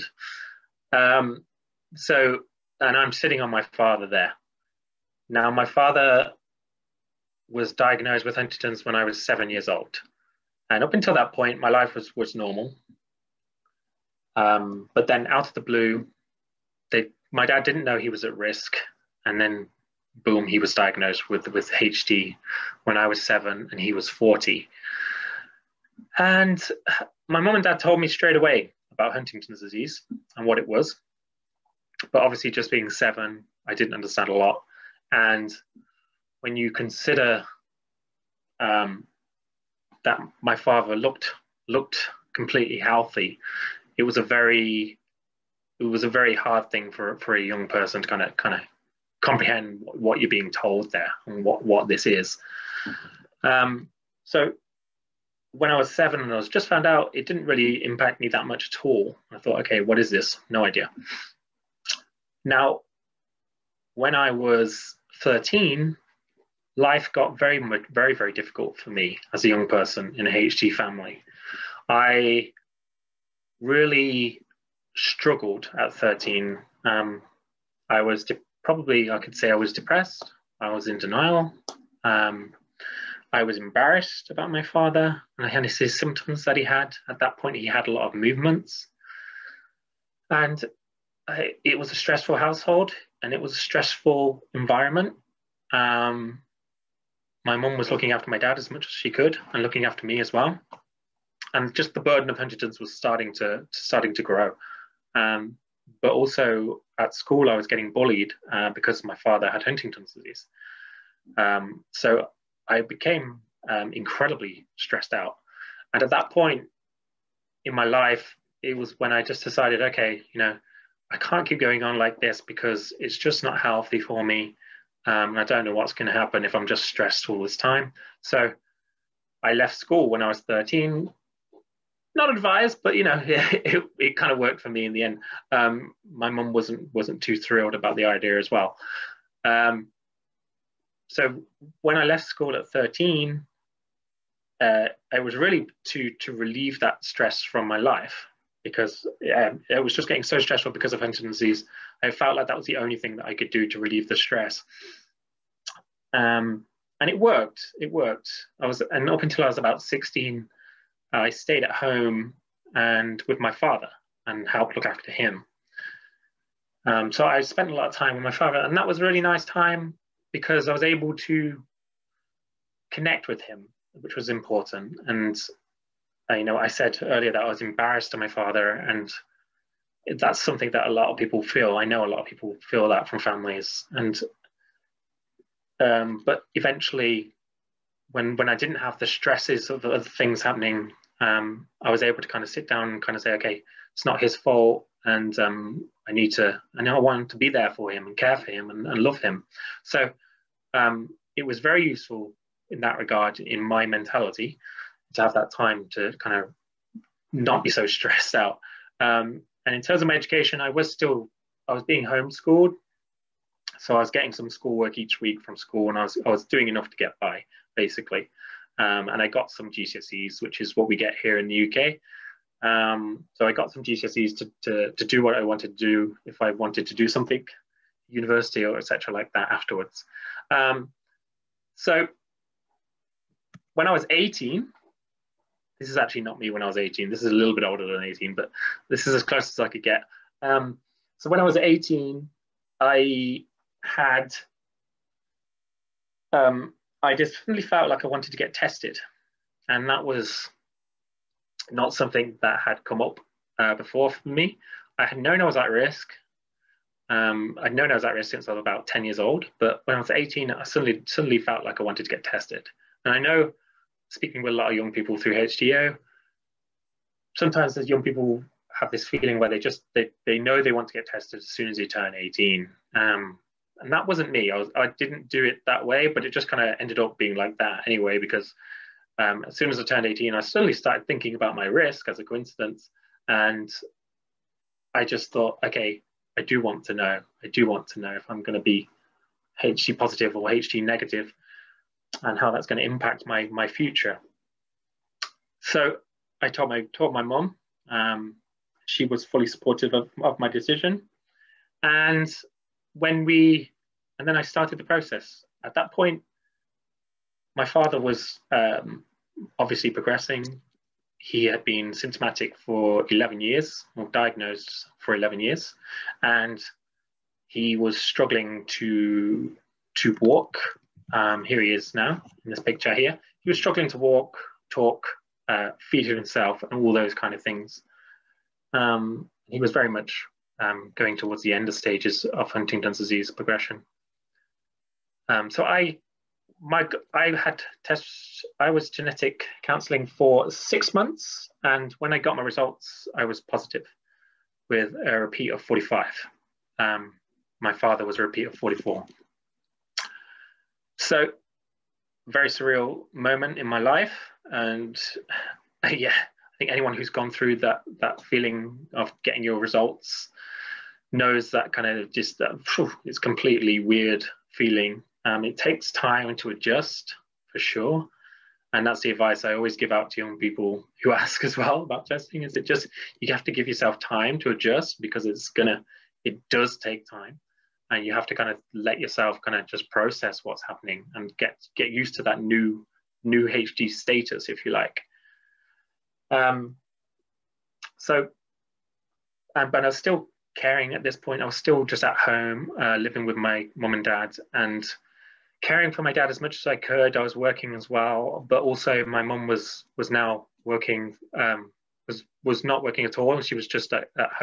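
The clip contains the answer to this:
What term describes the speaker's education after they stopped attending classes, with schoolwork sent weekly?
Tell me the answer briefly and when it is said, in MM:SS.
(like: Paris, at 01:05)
homeschooled, at 03:32.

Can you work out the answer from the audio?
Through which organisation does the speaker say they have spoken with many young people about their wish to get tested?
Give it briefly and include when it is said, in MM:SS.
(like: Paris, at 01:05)
HDYO, at 04:25.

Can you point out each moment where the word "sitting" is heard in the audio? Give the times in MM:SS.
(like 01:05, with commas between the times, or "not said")
00:03.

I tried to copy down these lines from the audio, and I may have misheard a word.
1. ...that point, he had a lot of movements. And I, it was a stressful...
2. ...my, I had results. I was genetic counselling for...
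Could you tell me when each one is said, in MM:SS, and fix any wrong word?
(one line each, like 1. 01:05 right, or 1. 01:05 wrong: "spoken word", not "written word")
1. 01:27 right
2. 05:36 wrong: "tests", not "results".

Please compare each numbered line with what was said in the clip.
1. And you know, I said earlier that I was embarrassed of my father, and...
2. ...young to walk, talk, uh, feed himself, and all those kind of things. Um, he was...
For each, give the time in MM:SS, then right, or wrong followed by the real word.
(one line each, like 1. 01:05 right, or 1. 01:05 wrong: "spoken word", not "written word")
1. 02:55 right
2. 05:23 wrong: "struggling", not "young".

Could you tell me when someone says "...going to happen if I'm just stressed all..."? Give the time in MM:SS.
02:05.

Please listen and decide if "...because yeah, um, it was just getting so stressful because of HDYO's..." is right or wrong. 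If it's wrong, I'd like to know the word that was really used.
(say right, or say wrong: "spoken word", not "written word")
wrong: "Huntington", not "HDYO".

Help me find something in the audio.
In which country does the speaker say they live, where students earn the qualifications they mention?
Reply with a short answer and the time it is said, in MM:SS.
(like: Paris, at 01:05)
UK, at 03:41.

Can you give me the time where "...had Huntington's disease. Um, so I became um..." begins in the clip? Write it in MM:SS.
01:49.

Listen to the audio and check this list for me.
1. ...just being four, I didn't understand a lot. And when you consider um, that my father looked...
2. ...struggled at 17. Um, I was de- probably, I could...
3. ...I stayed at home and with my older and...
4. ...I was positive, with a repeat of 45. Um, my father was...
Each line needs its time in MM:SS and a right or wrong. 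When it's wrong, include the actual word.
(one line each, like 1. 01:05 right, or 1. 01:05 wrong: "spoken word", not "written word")
1. 00:32 wrong: "seven", not "four"
2. 01:14 wrong: "13", not "17"
3. 02:41 wrong: "father", not "older"
4. 05:43 right.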